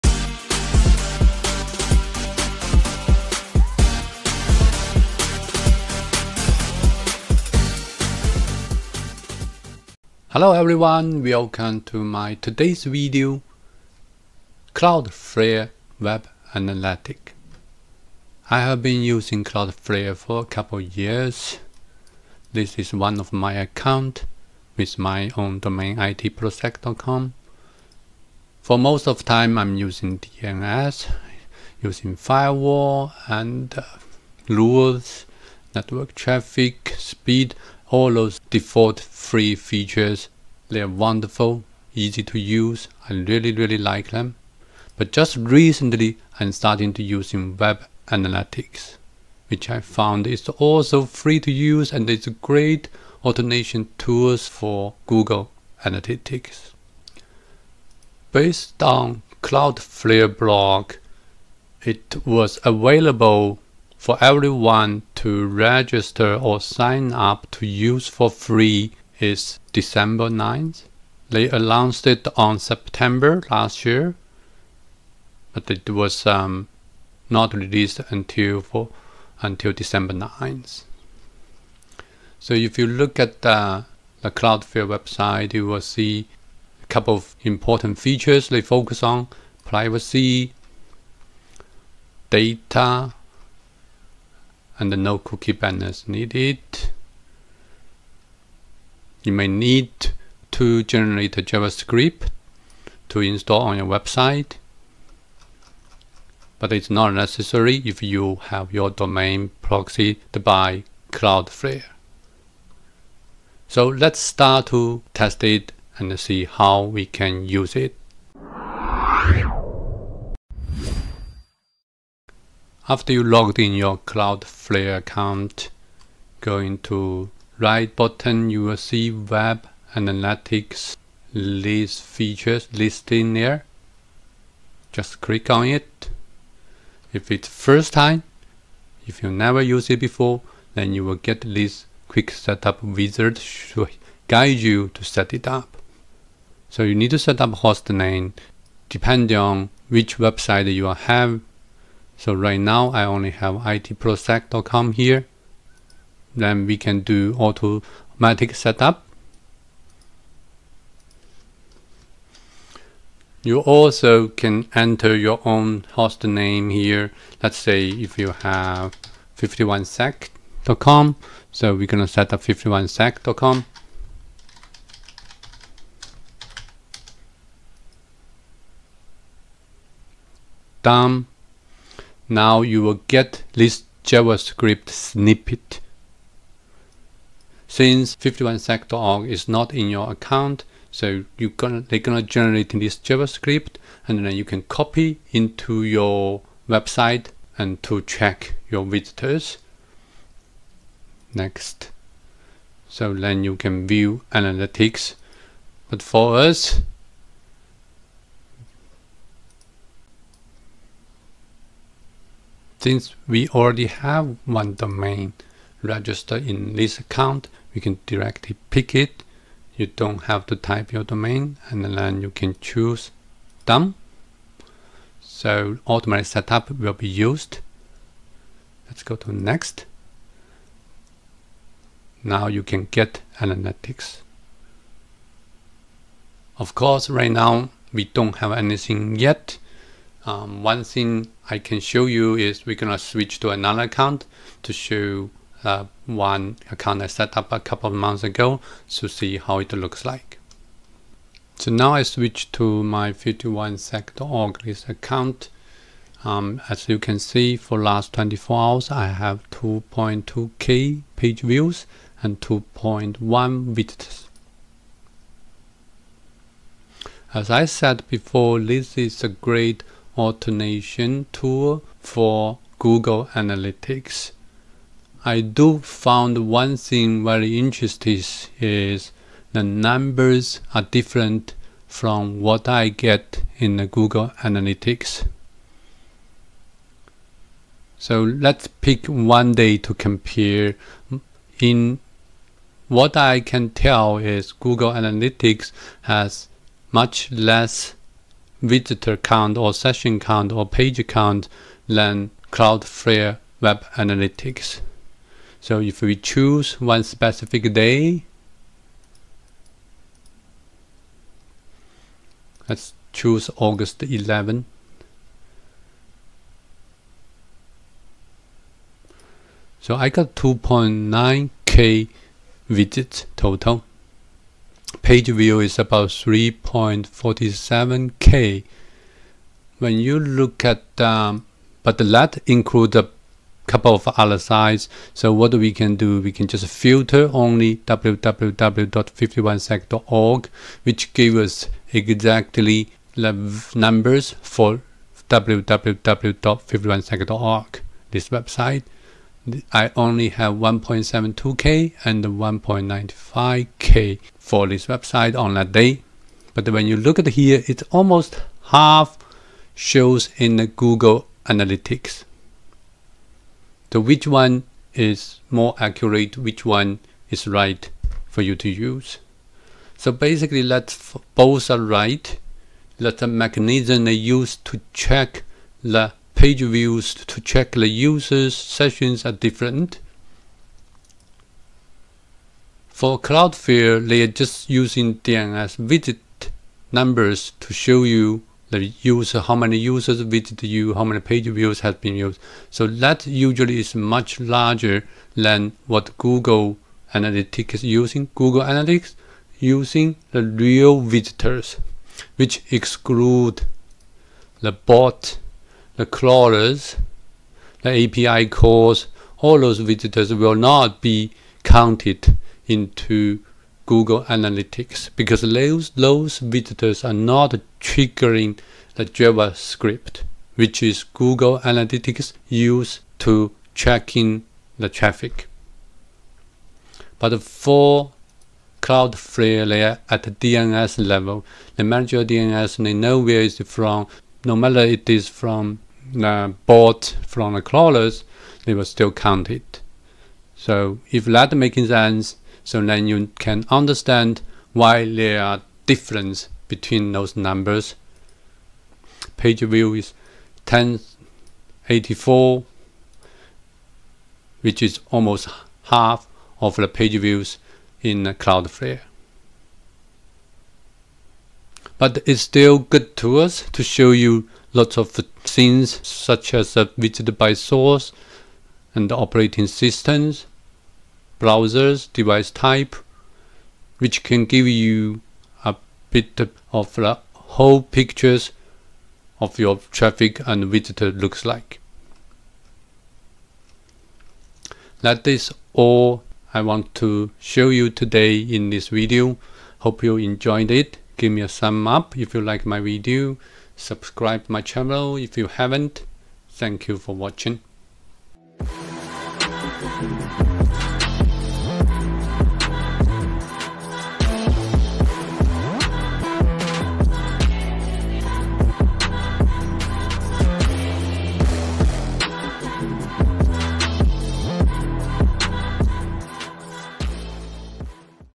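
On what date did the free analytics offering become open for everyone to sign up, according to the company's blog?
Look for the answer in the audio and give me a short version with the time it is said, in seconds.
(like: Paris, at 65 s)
December 9th, at 69 s.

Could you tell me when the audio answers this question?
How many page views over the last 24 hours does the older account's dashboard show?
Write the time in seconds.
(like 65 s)
259 s.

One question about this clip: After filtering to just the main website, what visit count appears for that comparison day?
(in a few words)
1.72k.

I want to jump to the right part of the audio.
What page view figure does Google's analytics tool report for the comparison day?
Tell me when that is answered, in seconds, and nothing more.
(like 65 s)
450 s.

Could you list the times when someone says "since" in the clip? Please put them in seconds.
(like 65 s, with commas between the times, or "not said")
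187 s, 212 s.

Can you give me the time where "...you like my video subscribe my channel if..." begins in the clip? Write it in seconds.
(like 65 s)
492 s.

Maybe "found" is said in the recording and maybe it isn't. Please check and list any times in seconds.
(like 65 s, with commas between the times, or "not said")
49 s, 275 s.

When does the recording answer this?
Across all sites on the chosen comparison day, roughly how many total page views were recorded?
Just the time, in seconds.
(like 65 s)
326 s.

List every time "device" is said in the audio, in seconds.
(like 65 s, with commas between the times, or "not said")
472 s.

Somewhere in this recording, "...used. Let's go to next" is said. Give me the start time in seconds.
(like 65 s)
227 s.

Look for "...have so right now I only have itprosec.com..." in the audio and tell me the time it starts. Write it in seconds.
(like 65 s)
150 s.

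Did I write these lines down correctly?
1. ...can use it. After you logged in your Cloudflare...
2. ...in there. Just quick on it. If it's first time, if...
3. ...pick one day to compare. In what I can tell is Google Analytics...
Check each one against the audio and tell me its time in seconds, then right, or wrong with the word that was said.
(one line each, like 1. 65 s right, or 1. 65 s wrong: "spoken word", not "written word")
1. 117 s right
2. 133 s wrong: "click", not "quick"
3. 288 s right.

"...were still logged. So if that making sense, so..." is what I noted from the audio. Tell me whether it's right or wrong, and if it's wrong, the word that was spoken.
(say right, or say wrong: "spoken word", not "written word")
wrong: "counted", not "logged".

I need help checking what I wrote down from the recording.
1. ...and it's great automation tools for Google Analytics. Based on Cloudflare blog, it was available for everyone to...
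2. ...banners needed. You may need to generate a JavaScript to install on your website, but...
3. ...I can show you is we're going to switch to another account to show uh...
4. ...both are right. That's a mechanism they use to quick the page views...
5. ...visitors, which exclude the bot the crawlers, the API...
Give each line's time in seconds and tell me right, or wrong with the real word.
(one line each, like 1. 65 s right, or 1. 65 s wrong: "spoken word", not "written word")
1. 51 s right
2. 95 s right
3. 241 s right
4. 371 s wrong: "check", not "quick"
5. 401 s right.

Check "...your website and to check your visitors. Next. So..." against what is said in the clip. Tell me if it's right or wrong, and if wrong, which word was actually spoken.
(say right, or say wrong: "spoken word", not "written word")
right.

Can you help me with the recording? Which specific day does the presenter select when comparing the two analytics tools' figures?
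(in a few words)
August 11.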